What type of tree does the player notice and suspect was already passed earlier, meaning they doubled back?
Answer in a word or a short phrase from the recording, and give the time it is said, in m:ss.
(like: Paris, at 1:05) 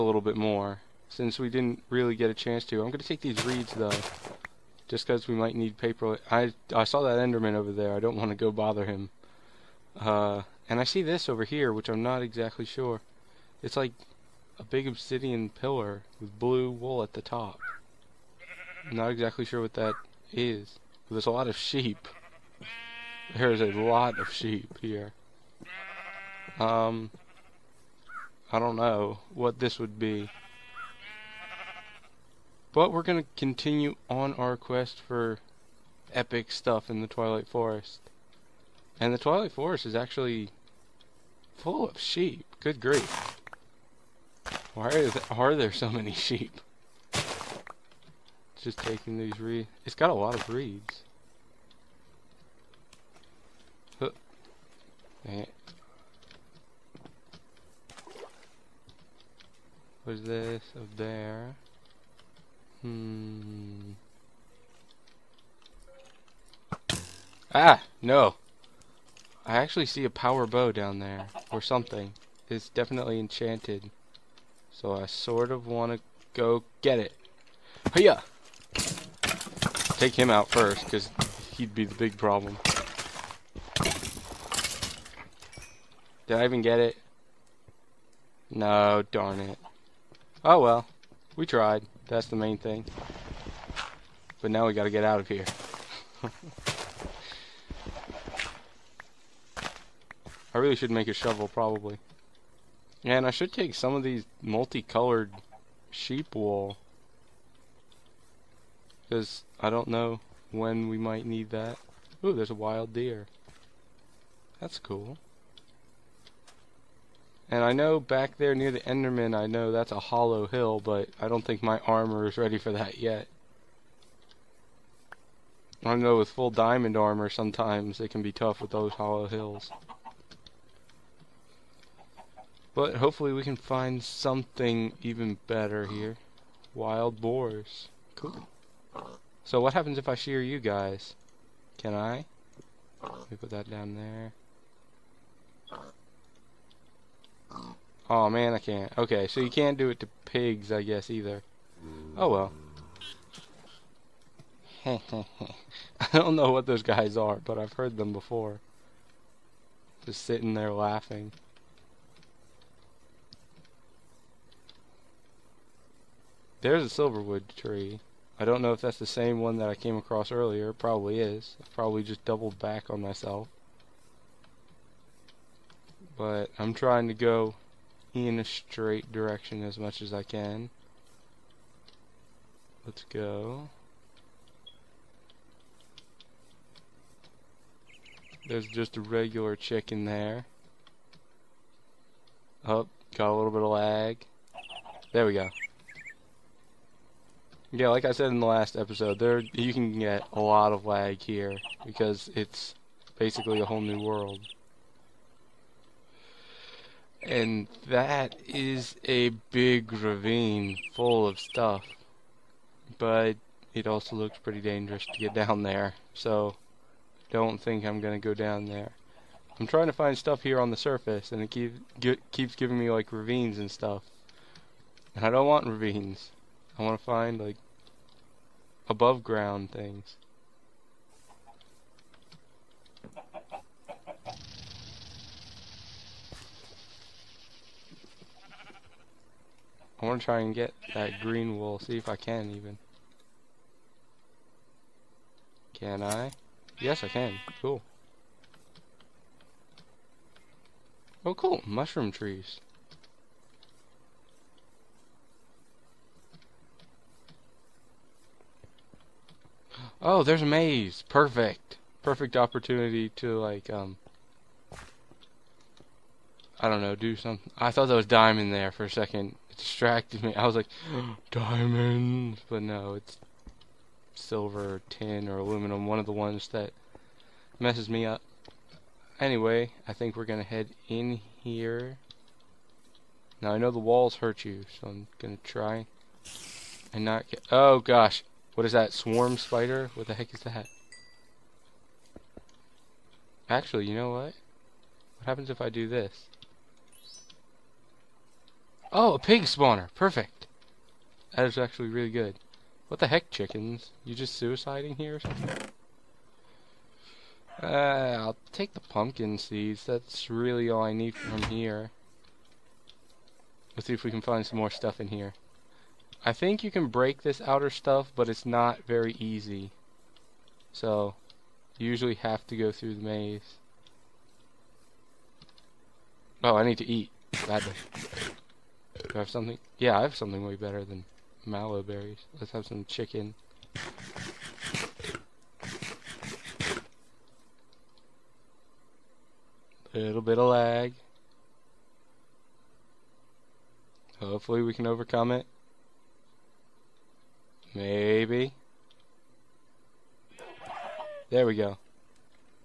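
Silverwood tree, at 2:47.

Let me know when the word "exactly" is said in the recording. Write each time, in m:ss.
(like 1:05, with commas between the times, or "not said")
0:12, 0:19.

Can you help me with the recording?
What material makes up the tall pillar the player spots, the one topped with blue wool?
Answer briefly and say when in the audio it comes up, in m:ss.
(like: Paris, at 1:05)
Obsidian, at 0:14.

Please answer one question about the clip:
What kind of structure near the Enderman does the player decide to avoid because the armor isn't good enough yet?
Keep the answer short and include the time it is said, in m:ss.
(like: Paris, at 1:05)
Hollow hill, at 1:59.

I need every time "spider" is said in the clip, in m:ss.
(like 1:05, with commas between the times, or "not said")
4:49.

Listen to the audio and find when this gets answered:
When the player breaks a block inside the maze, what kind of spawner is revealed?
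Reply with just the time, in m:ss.
4:59.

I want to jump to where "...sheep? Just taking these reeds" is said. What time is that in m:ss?
0:46.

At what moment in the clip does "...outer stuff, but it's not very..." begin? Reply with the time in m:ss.
5:17.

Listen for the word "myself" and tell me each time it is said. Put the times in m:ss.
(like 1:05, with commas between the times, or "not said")
2:53.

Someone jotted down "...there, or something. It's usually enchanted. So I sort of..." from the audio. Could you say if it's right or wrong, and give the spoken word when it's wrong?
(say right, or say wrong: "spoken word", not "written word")
wrong: "definitely", not "usually".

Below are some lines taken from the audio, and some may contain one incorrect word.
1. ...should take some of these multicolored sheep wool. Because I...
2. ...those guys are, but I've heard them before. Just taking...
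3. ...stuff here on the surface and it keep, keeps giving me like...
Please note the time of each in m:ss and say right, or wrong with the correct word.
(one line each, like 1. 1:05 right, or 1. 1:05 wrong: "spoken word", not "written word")
1. 1:43 right
2. 2:36 wrong: "sitting", not "taking"
3. 3:40 right.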